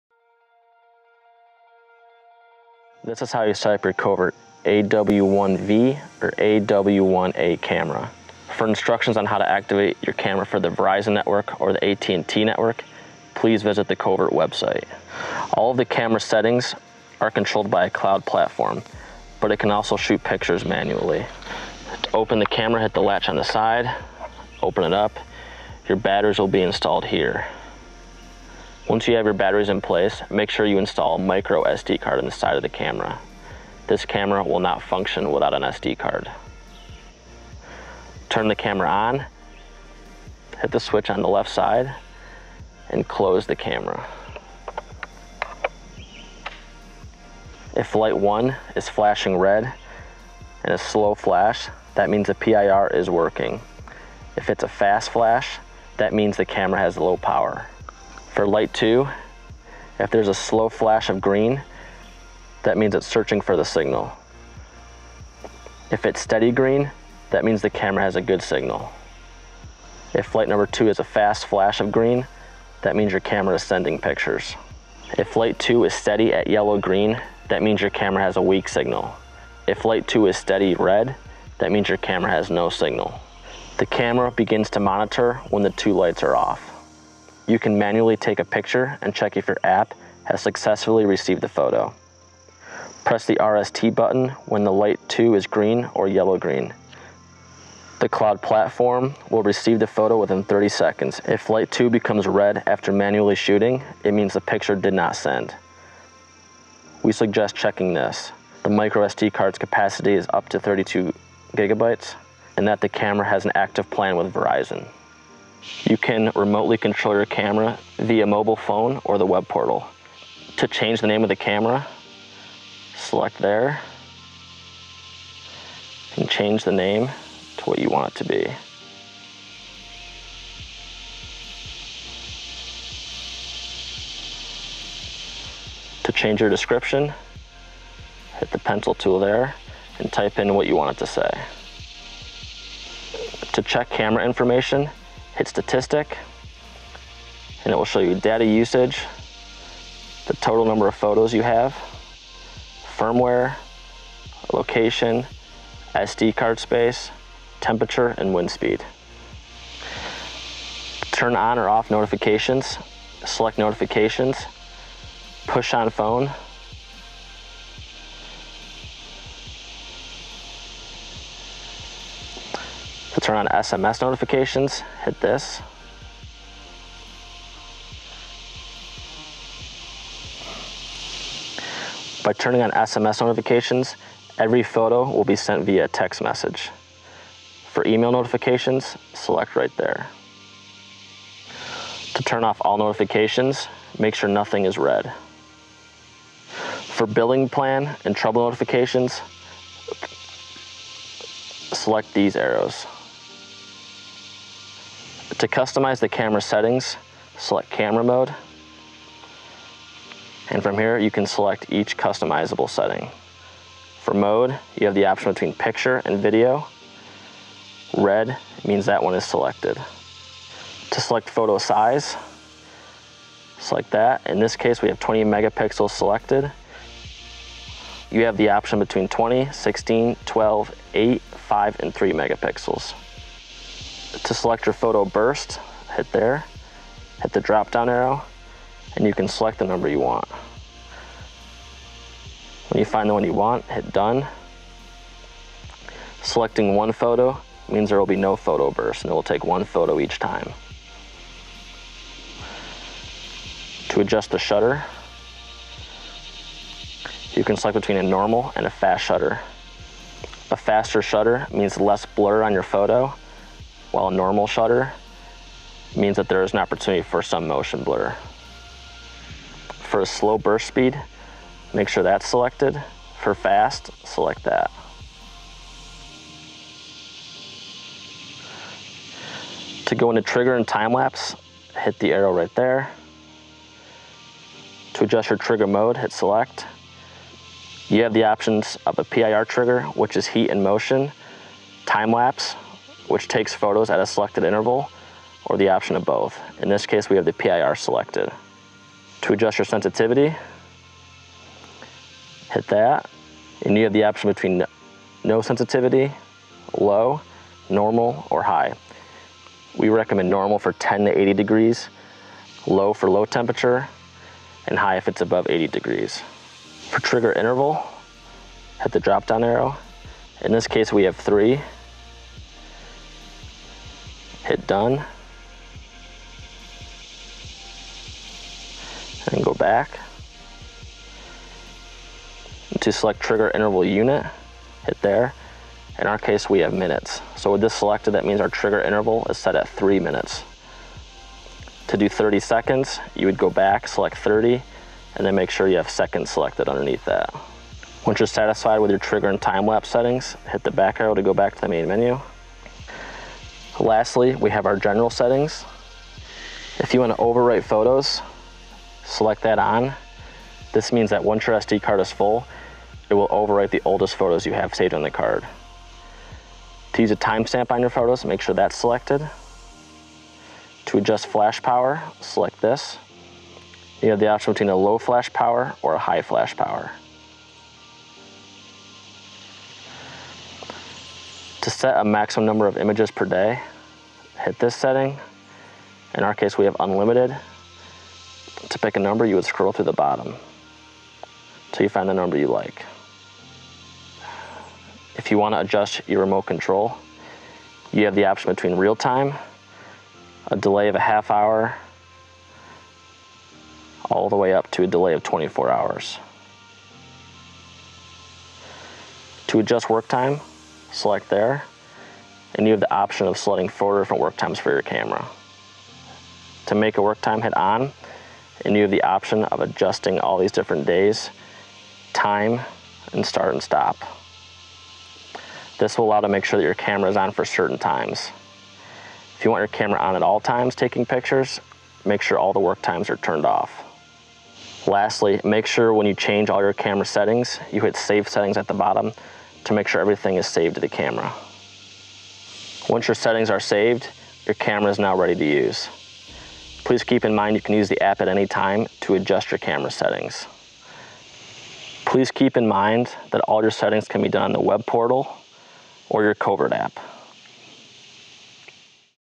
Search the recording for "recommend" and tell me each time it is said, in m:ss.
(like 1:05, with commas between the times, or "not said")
5:09.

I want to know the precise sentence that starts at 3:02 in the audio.
By turning on SMS notifications, every photo will be sent via text message.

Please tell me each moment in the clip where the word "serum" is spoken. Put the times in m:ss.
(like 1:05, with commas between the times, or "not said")
not said.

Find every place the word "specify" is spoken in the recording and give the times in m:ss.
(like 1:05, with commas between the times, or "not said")
not said.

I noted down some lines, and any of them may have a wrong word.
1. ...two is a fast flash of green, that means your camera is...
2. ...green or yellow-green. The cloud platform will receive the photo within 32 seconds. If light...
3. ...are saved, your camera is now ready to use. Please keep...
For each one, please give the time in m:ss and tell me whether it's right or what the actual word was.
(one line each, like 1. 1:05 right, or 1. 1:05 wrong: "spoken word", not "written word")
1. 1:10 right
2. 1:35 wrong: "30", not "32"
3. 7:23 right.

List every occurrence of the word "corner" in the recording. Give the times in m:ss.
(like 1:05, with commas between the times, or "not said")
not said.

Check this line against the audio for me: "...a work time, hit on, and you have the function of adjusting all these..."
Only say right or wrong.
wrong.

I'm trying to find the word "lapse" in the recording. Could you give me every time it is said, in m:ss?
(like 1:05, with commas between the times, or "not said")
4:40, 4:52, 5:49.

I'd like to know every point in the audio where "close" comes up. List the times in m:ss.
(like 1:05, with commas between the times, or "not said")
0:43.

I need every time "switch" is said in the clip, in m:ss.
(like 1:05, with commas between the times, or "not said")
0:40.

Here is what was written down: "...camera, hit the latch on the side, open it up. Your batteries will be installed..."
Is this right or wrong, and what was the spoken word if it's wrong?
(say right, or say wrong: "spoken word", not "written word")
right.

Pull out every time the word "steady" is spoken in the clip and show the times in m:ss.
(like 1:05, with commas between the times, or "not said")
1:06, 1:15, 1:20.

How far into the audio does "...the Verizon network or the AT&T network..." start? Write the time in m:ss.
0:10.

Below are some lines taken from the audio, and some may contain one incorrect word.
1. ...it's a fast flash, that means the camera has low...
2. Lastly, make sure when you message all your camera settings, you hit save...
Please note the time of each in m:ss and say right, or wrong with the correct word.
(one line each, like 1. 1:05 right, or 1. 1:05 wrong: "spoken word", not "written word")
1. 0:54 right
2. 7:14 wrong: "change", not "message".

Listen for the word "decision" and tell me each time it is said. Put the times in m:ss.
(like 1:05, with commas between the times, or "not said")
not said.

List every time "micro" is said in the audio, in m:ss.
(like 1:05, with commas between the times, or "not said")
0:31, 1:48.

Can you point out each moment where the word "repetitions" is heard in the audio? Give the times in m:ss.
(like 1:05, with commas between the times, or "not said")
not said.